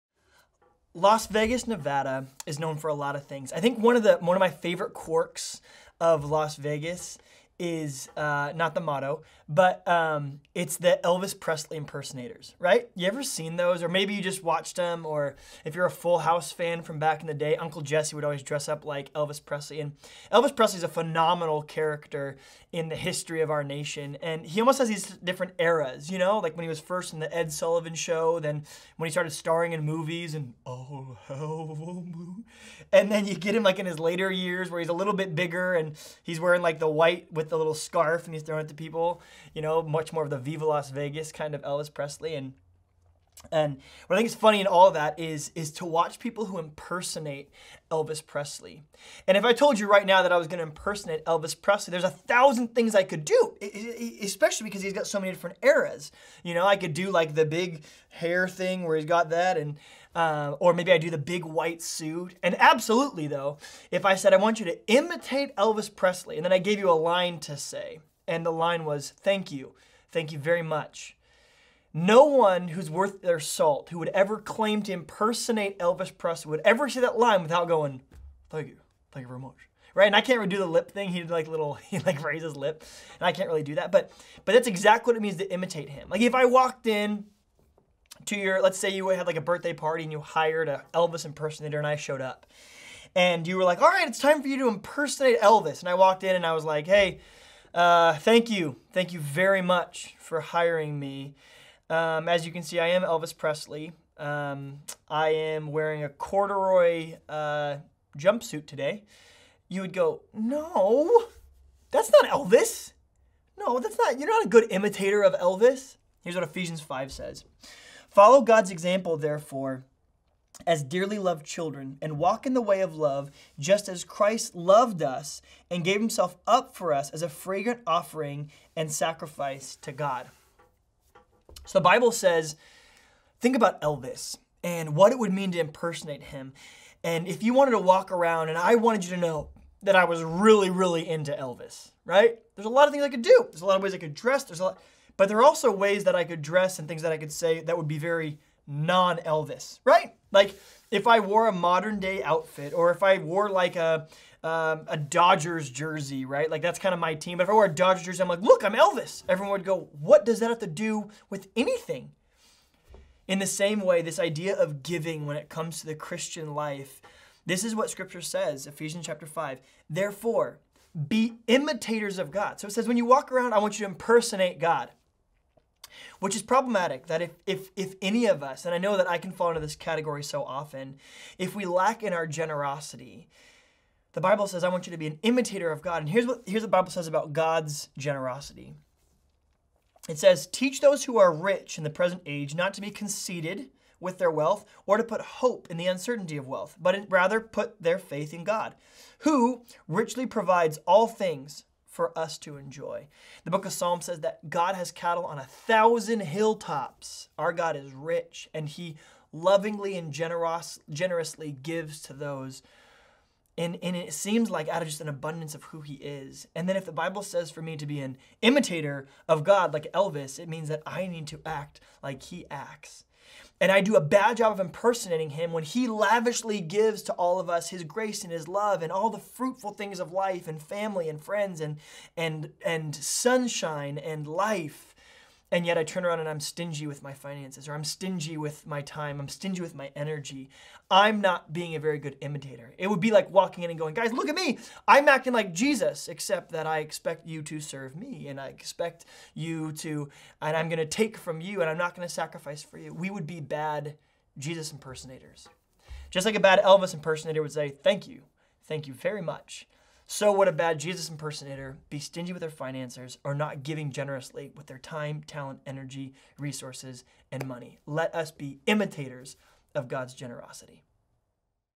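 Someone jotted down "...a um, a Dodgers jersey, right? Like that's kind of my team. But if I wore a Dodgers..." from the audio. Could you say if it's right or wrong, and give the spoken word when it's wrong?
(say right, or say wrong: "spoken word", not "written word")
right.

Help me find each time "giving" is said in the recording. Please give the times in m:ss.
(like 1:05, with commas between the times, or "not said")
2:44, 4:23.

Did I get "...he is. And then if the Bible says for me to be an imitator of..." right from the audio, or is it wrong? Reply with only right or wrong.
right.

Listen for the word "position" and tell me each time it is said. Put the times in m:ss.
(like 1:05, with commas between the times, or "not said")
not said.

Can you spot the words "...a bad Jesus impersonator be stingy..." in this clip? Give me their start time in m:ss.
4:20.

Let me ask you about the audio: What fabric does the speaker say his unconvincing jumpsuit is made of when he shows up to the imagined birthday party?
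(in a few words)
Corduroy.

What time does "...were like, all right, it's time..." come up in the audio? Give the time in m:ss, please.
1:33.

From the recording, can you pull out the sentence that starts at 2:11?
So the Bible says, think about Elvis and what it would mean to impersonate him.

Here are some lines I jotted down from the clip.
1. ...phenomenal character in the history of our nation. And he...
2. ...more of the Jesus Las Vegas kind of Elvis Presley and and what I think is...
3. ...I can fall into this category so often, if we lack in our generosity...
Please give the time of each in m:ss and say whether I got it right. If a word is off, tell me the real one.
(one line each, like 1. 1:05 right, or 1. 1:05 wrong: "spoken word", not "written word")
1. 0:20 right
2. 0:40 wrong: "Viva", not "Jesus"
3. 2:59 right.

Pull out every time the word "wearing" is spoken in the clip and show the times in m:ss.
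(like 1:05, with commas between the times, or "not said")
0:36, 1:45.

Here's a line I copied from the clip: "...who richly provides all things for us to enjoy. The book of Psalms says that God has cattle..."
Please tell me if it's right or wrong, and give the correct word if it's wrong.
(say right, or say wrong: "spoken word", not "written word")
right.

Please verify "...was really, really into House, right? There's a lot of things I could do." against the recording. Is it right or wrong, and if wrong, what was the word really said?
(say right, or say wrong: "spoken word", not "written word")
wrong: "Elvis", not "House".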